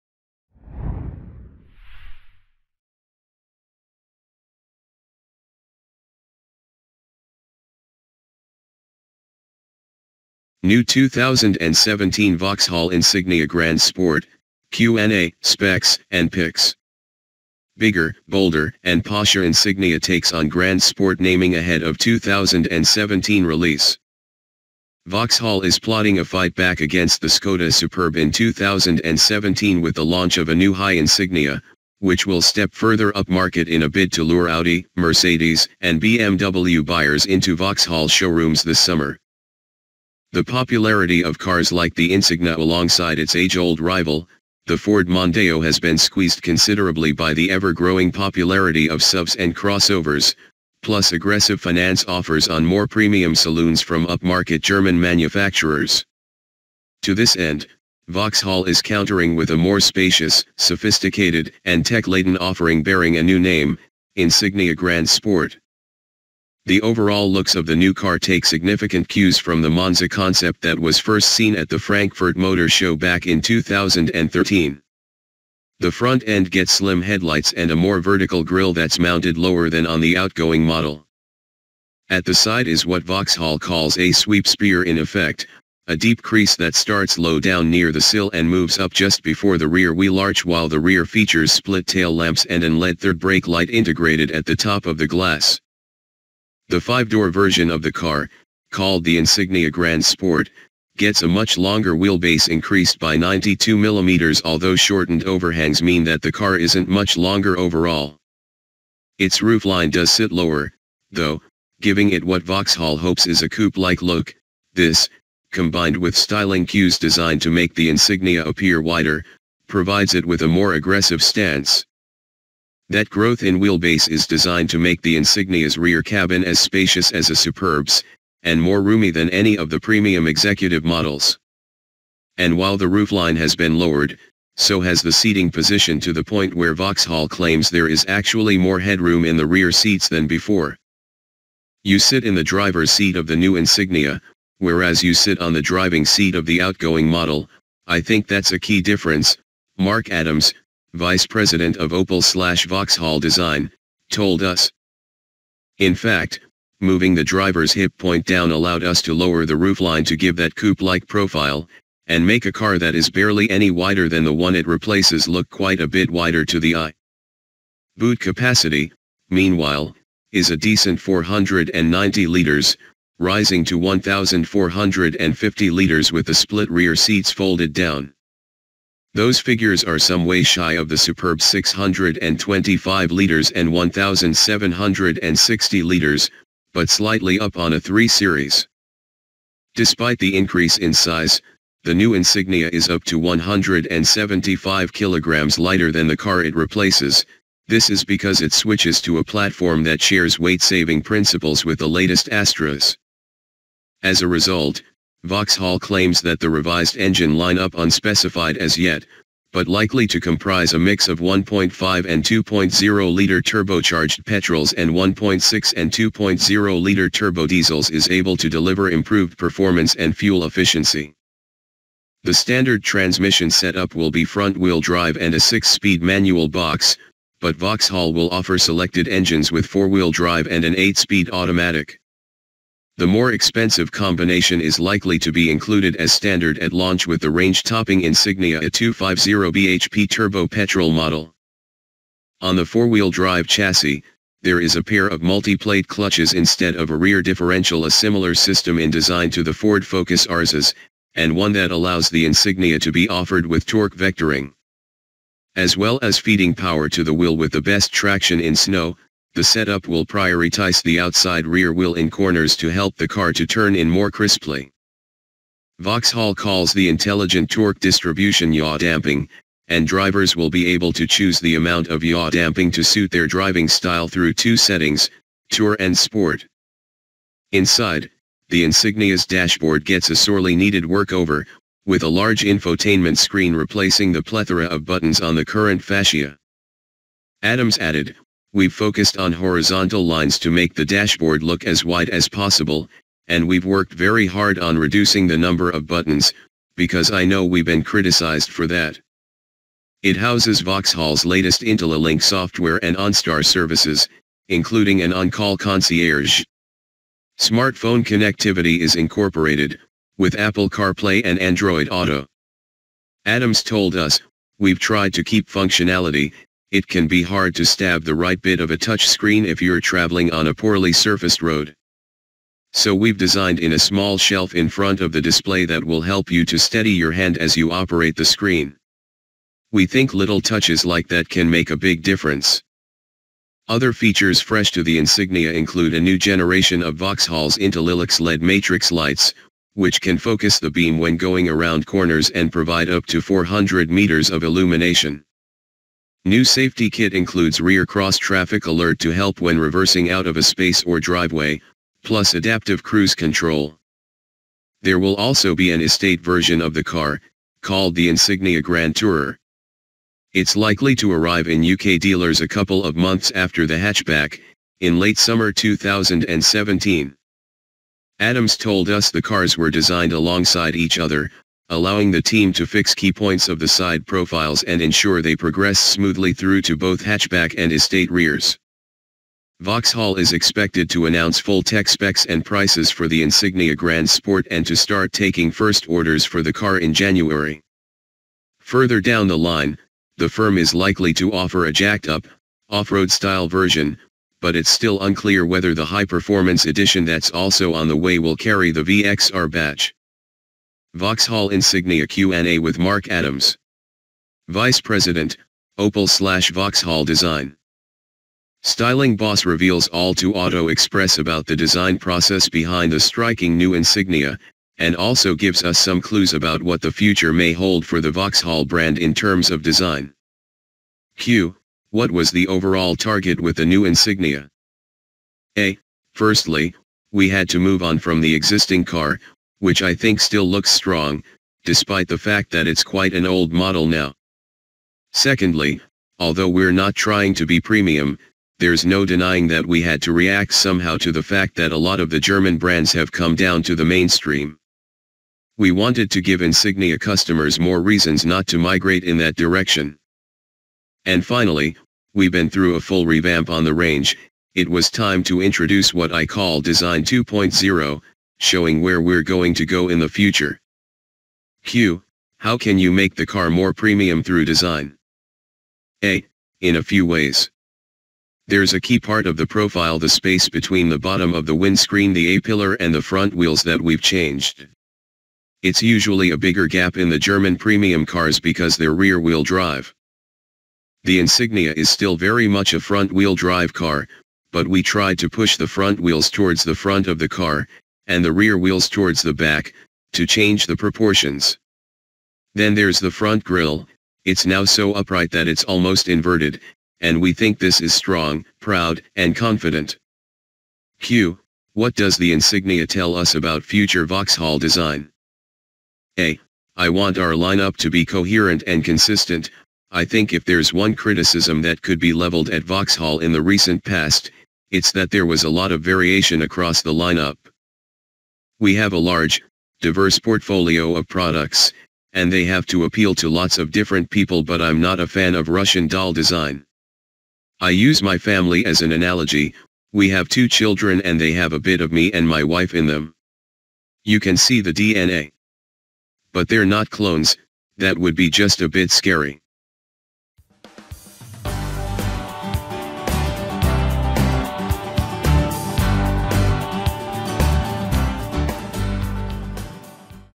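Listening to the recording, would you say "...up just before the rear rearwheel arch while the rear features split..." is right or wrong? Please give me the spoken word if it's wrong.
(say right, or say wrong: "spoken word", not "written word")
wrong: "wheel", not "rearwheel".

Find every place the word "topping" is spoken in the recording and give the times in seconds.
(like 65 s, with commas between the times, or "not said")
237 s.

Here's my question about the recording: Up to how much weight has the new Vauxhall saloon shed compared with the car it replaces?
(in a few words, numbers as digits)
175 kilograms.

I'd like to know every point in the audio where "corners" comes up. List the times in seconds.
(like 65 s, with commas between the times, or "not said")
262 s, 341 s.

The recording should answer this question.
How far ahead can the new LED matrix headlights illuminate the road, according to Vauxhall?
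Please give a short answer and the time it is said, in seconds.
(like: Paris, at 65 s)
400 meters, at 343 s.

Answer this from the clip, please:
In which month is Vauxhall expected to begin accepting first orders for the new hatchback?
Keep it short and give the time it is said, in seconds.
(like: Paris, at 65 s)
January, at 386 s.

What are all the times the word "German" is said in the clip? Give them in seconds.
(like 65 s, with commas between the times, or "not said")
54 s, 442 s, 477 s.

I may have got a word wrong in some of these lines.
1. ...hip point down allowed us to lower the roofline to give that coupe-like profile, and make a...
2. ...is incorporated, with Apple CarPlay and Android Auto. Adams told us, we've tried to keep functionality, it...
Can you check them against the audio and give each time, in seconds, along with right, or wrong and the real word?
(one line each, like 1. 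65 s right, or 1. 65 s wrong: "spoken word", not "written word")
1. 157 s right
2. 308 s right.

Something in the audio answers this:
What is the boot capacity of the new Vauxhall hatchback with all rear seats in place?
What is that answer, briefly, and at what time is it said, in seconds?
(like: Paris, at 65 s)
490 liters, at 170 s.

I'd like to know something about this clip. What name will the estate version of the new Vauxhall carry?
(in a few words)
Insignia Grand Tourer.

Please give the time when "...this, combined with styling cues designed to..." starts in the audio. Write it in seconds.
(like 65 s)
114 s.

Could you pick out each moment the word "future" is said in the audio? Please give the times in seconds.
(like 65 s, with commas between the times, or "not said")
416 s, 460 s, 503 s.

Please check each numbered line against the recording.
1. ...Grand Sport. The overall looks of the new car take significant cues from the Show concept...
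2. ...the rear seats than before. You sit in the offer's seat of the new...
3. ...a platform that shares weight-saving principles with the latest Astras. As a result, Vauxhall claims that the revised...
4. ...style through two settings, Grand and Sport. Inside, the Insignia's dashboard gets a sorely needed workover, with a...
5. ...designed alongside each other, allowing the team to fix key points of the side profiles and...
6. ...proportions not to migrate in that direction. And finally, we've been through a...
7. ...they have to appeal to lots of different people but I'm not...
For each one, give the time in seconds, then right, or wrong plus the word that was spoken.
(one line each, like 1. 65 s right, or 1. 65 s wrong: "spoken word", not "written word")
1. 64 s wrong: "Monza", not "Show"
2. 139 s wrong: "driver", not "offer"
3. 199 s right
4. 273 s wrong: "Tour", not "Grand"
5. 369 s right
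6. 447 s wrong: "reasons", not "proportions"
7. 522 s right.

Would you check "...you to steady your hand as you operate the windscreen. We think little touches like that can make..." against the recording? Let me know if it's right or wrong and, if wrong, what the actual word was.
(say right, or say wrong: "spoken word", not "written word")
wrong: "screen", not "windscreen".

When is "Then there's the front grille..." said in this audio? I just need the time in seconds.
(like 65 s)
492 s.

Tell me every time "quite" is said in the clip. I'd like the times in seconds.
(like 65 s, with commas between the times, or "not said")
165 s, 432 s.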